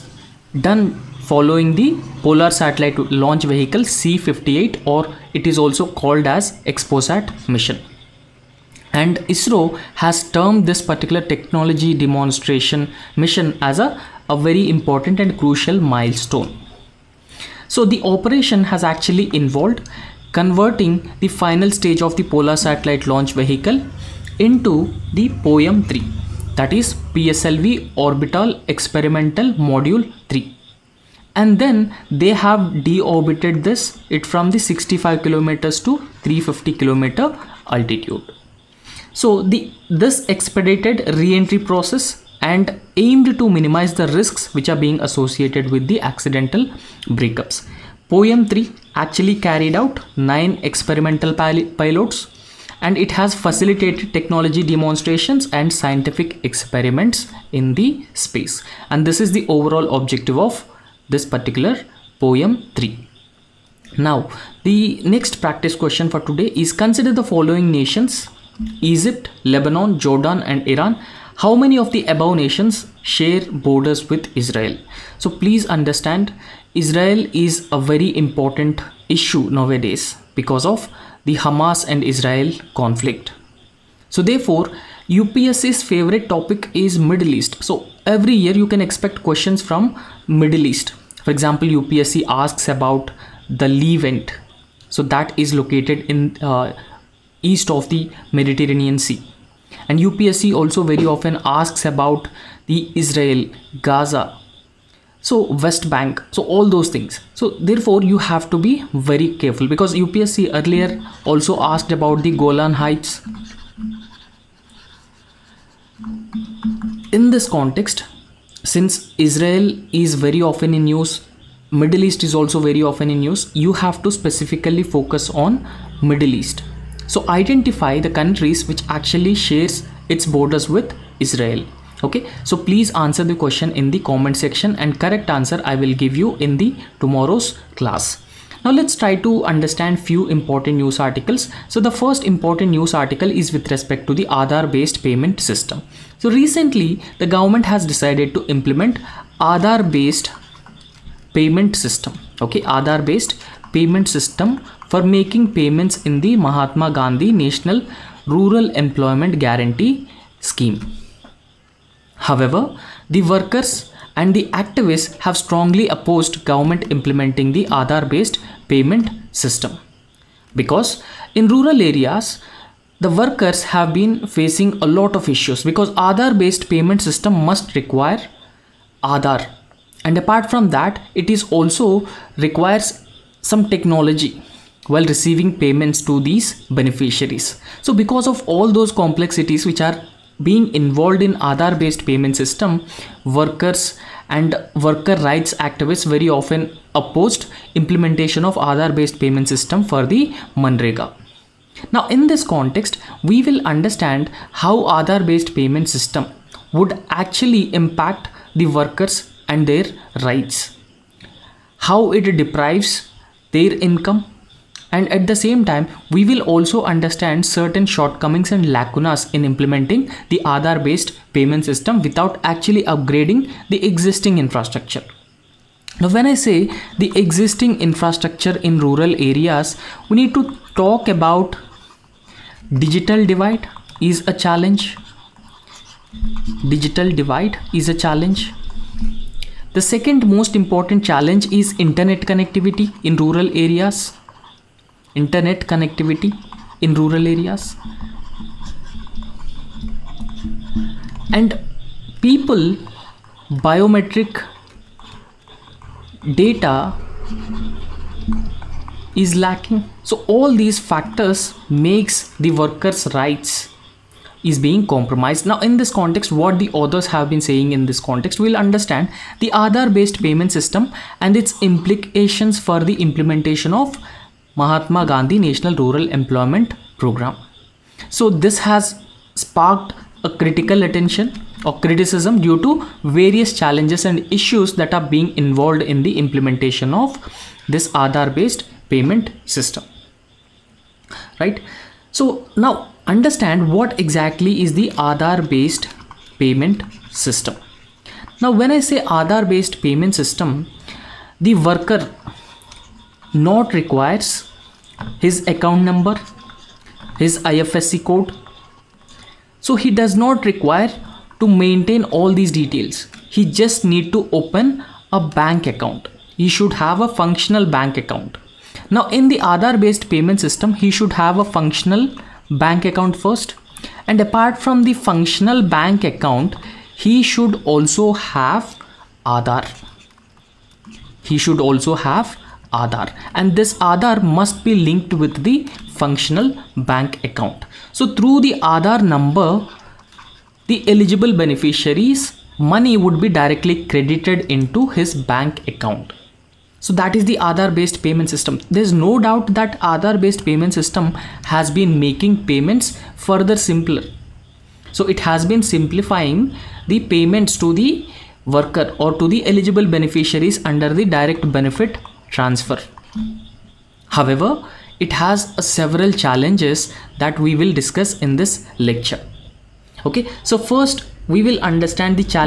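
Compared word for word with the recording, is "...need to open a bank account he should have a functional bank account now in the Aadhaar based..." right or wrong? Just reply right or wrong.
right.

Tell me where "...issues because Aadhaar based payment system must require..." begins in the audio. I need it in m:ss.
2:55.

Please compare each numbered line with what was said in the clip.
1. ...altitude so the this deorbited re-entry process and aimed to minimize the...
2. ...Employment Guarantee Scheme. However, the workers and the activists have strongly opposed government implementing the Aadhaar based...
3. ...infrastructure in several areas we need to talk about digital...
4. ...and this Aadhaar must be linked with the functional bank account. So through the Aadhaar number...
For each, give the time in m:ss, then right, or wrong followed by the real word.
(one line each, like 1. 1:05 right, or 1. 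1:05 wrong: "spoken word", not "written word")
1. 0:37 wrong: "expedited", not "deorbited"
2. 2:38 right
3. 3:47 wrong: "rural", not "several"
4. 5:33 right.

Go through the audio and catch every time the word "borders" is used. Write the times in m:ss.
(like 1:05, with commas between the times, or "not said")
1:13, 2:10.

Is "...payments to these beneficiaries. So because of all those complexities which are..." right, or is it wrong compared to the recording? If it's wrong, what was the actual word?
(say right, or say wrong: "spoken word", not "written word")
right.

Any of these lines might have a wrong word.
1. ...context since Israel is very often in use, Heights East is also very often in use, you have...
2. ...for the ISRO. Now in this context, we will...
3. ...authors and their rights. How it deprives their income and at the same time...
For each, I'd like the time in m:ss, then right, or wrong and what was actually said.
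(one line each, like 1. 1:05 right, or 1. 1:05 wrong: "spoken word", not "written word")
1. 1:57 wrong: "Middle", not "Heights"
2. 3:19 wrong: "Manrega", not "ISRO"
3. 3:28 wrong: "workers", not "authors".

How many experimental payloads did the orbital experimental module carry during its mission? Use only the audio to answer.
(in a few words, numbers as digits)
9.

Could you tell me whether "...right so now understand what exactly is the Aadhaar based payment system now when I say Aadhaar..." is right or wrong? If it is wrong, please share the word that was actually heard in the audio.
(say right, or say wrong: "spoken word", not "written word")
right.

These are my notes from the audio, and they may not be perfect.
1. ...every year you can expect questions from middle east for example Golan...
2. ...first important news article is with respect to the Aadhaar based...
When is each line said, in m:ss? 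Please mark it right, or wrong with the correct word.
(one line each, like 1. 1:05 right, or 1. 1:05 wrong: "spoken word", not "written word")
1. 1:28 wrong: "UPSC", not "Golan"
2. 2:21 right.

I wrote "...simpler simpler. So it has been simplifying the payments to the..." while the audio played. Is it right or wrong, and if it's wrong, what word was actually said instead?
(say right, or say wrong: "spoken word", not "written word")
wrong: "further", not "simpler".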